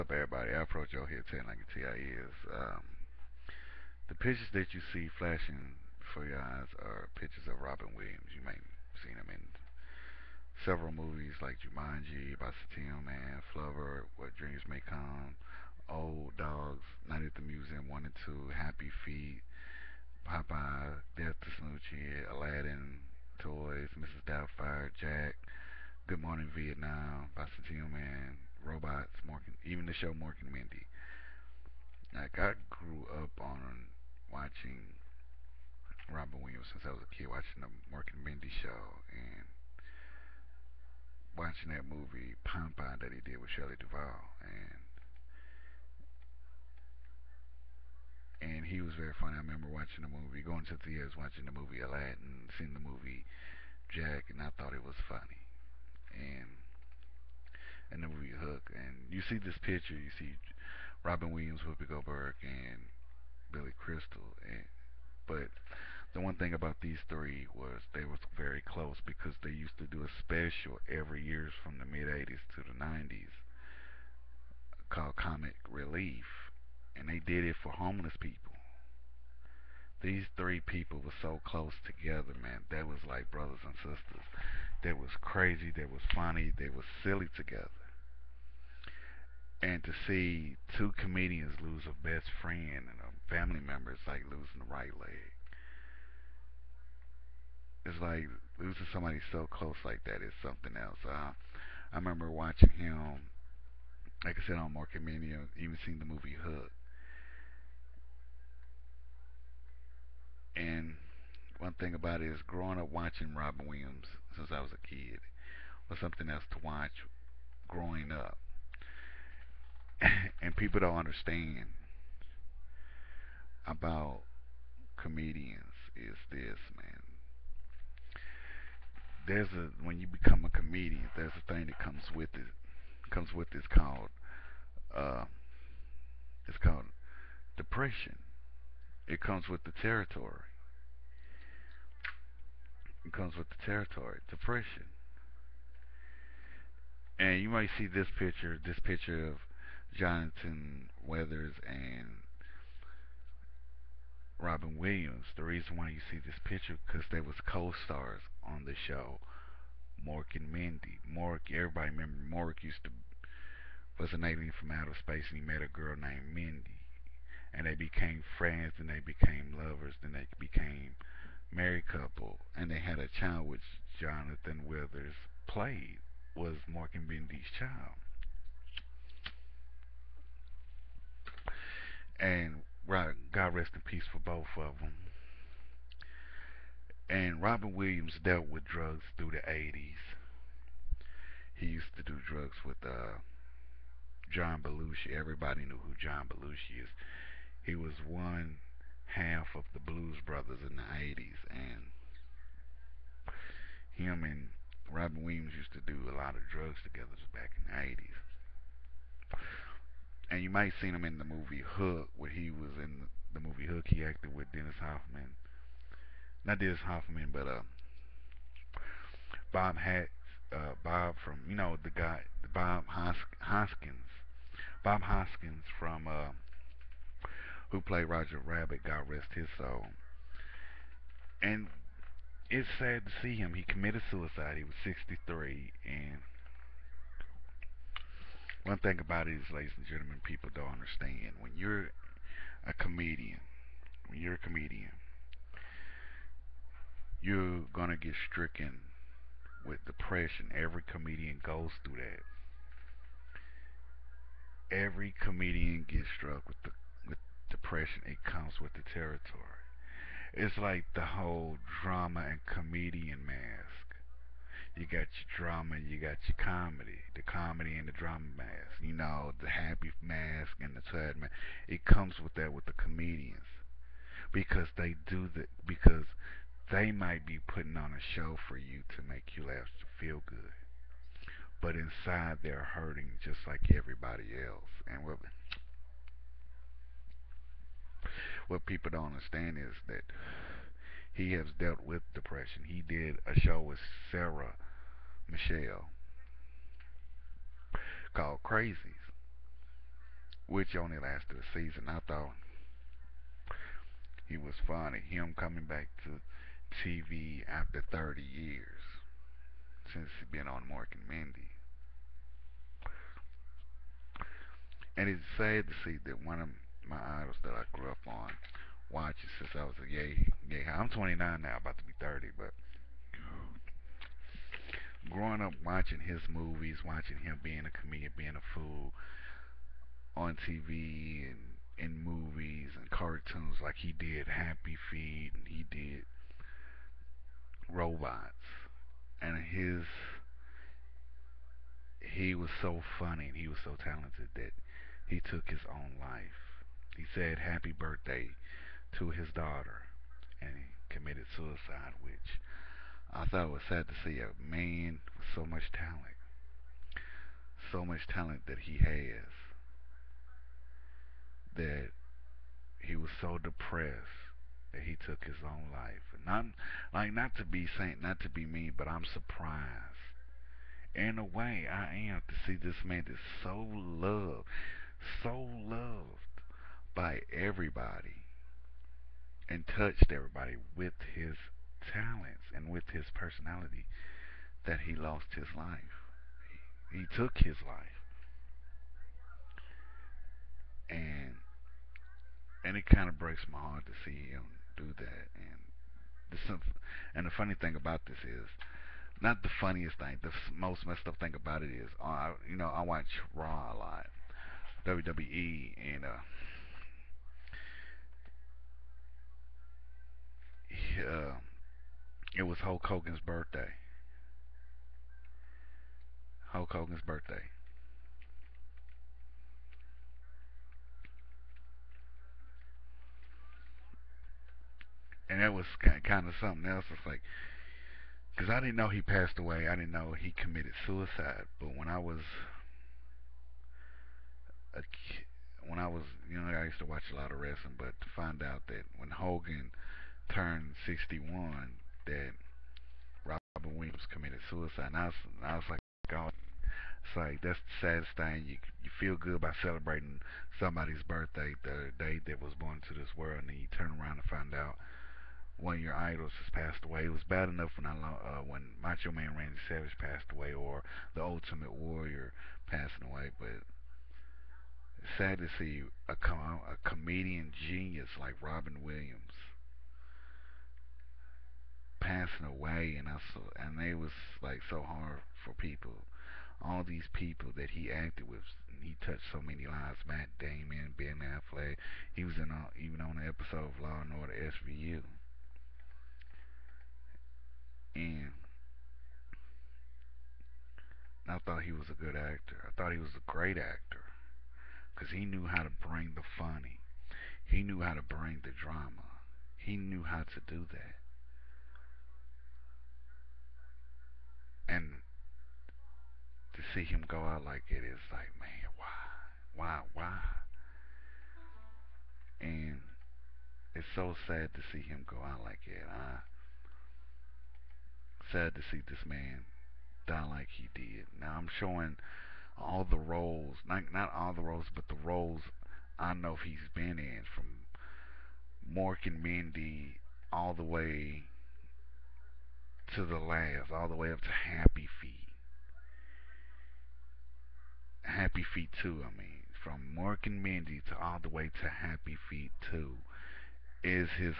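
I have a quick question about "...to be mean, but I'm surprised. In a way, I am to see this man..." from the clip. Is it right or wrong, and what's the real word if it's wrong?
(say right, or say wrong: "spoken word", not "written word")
right.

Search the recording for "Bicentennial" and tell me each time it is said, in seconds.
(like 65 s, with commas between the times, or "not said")
12 s, 27 s.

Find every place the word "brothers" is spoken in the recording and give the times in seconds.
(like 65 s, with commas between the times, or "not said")
83 s, 200 s.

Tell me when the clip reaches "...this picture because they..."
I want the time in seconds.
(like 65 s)
156 s.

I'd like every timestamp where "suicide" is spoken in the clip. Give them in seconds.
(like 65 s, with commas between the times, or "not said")
234 s, 351 s, 430 s, 444 s.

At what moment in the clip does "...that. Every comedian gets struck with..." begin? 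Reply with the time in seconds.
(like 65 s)
251 s.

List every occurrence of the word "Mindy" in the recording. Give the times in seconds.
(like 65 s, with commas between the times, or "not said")
30 s, 38 s, 160 s, 166 s, 177 s, 311 s, 529 s, 540 s.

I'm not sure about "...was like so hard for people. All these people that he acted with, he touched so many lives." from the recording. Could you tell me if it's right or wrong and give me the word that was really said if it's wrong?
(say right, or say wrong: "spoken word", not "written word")
right.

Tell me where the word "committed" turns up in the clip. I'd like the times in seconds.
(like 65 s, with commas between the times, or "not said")
233 s, 350 s, 430 s.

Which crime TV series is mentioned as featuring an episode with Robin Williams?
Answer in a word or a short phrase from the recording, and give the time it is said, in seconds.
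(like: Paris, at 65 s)
Law and Order SVU, at 483 s.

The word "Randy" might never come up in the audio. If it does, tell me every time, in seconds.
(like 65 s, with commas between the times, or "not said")
459 s.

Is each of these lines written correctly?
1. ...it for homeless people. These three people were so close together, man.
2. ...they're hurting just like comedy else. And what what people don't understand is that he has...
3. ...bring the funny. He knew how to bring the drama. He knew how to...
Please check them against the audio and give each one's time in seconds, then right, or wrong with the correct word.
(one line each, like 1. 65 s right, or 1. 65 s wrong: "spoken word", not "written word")
1. 77 s right
2. 282 s wrong: "everybody", not "comedy"
3. 495 s right.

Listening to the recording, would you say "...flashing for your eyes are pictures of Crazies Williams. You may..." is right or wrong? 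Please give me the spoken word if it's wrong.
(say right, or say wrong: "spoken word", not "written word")
wrong: "Robin", not "Crazies".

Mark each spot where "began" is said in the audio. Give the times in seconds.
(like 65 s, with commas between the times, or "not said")
not said.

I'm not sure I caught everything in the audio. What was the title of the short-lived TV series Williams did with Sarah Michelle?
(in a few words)
Crazies.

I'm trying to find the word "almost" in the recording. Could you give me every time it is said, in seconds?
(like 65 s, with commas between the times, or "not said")
not said.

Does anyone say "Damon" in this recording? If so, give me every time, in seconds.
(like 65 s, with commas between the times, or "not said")
480 s.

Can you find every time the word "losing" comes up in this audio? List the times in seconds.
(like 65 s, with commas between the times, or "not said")
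94 s, 98 s.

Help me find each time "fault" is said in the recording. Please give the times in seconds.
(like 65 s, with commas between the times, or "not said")
not said.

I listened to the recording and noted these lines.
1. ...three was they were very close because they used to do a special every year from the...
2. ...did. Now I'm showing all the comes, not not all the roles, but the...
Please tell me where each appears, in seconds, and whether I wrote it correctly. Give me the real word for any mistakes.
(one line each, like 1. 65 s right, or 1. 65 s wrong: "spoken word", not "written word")
1. 67 s right
2. 520 s wrong: "roles", not "comes".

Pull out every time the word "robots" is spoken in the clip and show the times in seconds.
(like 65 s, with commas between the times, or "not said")
28 s, 337 s.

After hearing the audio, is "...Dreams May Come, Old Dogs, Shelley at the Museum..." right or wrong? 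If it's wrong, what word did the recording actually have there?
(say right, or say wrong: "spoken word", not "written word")
wrong: "Night", not "Shelley".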